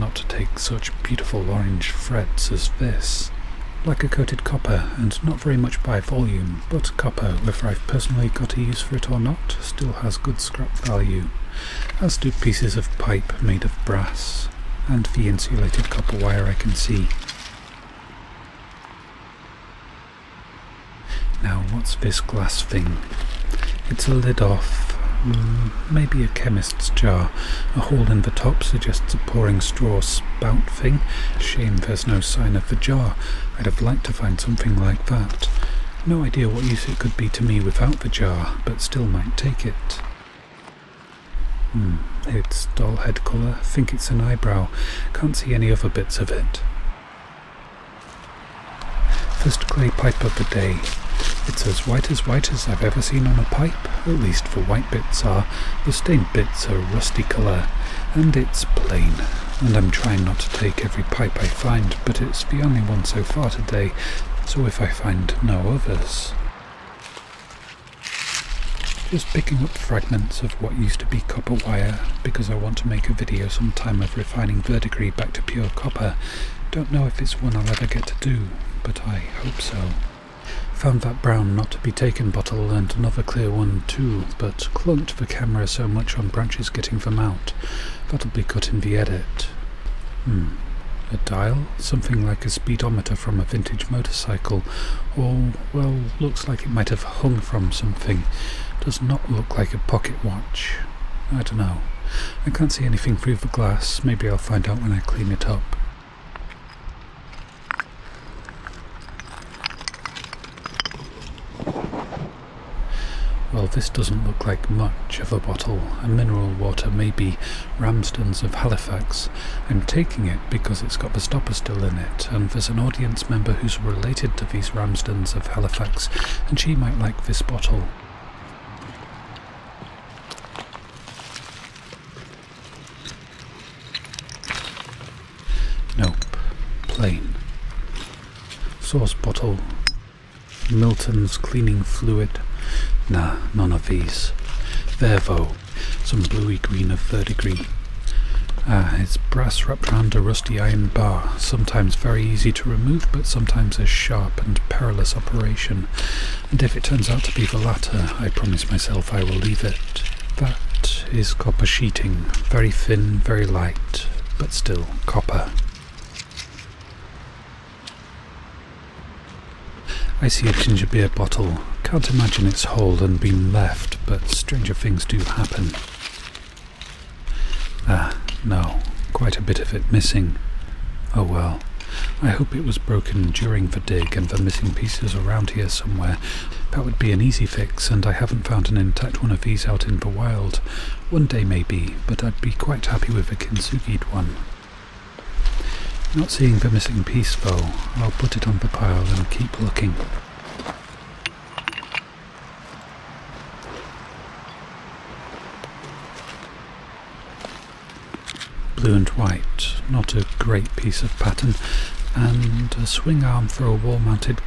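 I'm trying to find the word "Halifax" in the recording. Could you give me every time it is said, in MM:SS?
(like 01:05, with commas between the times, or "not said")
01:58, 02:05.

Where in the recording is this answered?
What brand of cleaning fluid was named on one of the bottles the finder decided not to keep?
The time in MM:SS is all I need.
02:20.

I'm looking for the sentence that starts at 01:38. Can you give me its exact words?
Does not look like a pocket watch.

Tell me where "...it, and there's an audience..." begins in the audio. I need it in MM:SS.
02:01.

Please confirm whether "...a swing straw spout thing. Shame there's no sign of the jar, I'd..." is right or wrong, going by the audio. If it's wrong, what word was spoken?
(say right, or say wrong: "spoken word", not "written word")
wrong: "pouring", not "swing".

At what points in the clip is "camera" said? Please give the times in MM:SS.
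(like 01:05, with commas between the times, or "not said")
01:25.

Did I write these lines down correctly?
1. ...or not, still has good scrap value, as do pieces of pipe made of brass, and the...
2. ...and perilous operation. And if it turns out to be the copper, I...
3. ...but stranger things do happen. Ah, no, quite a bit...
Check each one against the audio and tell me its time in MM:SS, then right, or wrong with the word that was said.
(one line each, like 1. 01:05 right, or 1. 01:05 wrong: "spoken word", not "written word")
1. 00:09 right
2. 02:34 wrong: "latter", not "copper"
3. 02:54 right.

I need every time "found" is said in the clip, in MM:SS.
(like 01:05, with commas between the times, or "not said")
01:20, 03:08.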